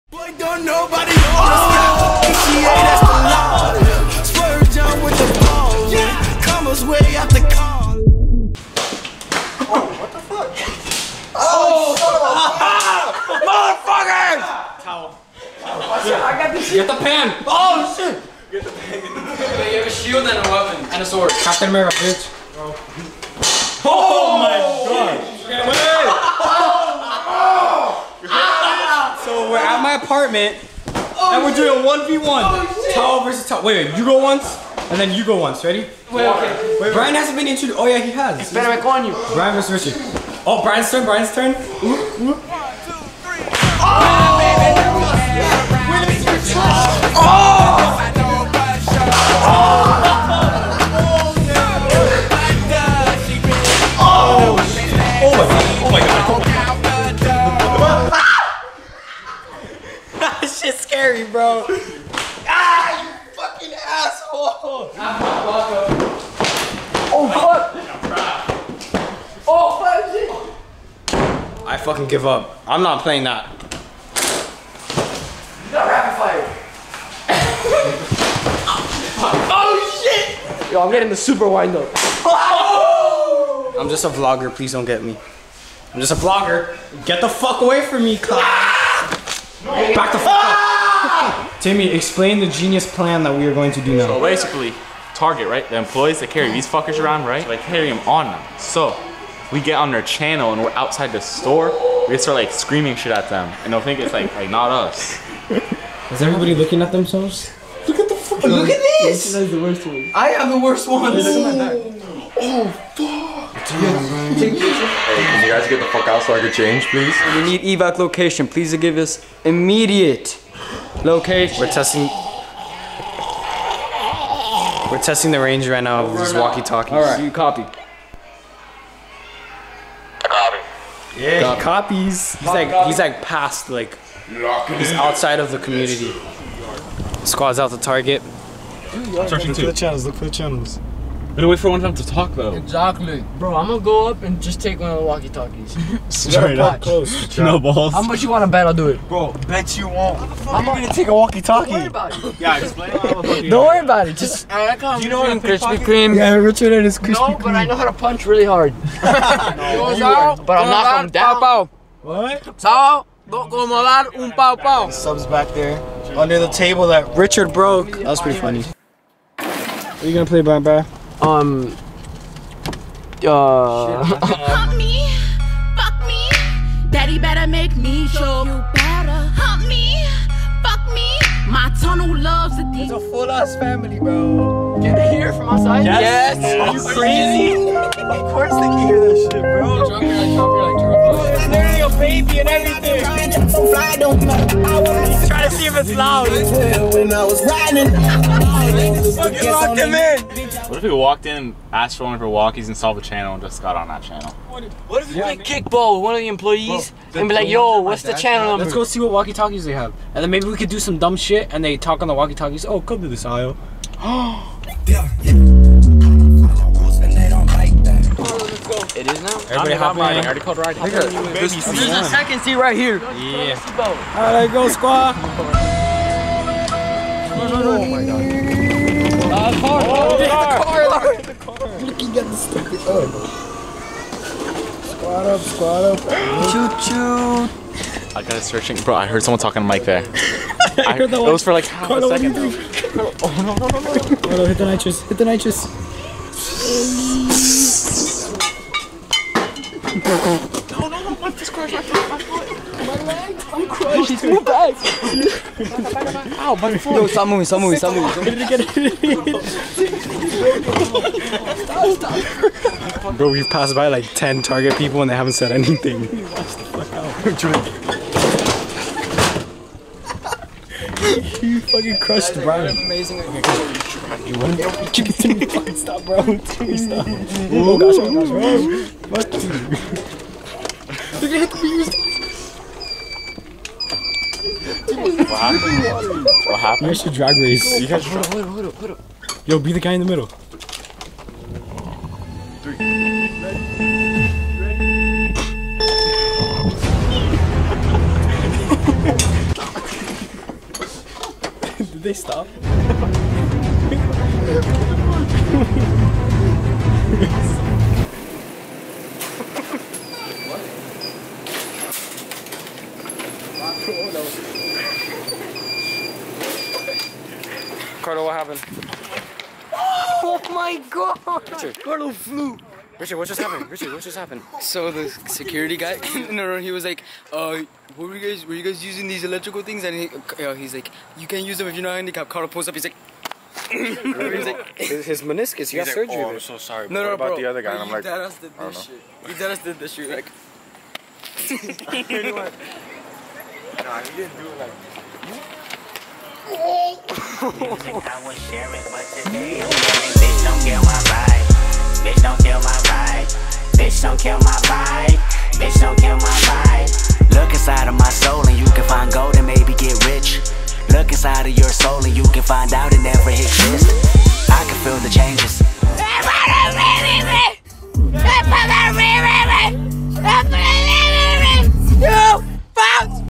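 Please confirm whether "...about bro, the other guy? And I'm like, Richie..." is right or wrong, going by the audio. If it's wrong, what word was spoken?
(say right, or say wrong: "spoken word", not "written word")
wrong: "Dadas", not "Richie".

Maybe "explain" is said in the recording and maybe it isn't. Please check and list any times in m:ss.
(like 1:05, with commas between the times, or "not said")
1:31, 2:32.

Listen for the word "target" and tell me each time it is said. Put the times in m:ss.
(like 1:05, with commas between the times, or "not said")
1:35, 2:17, 4:24.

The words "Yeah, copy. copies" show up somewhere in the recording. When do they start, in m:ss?
2:11.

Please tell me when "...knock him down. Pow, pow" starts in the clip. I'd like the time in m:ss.
2:40.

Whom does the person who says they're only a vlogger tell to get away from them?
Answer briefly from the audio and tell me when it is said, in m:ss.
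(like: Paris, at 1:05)
Cloud, at 1:28.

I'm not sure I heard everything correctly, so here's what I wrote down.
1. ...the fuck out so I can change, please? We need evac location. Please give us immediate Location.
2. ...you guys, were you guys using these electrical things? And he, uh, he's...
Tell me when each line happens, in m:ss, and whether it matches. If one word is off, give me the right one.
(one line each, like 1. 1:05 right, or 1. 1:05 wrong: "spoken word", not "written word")
1. 1:55 right
2. 5:28 right.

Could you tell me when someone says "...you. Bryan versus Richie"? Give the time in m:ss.
0:39.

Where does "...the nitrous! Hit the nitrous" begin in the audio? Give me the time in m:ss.
4:04.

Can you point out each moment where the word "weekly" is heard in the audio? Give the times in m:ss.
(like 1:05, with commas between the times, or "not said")
not said.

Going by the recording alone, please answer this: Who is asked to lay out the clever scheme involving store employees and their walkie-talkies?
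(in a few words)
Timmy.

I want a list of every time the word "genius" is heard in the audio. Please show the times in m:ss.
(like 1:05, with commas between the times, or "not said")
1:32.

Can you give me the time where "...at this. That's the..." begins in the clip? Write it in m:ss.
1:48.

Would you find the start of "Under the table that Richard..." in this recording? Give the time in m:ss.
2:46.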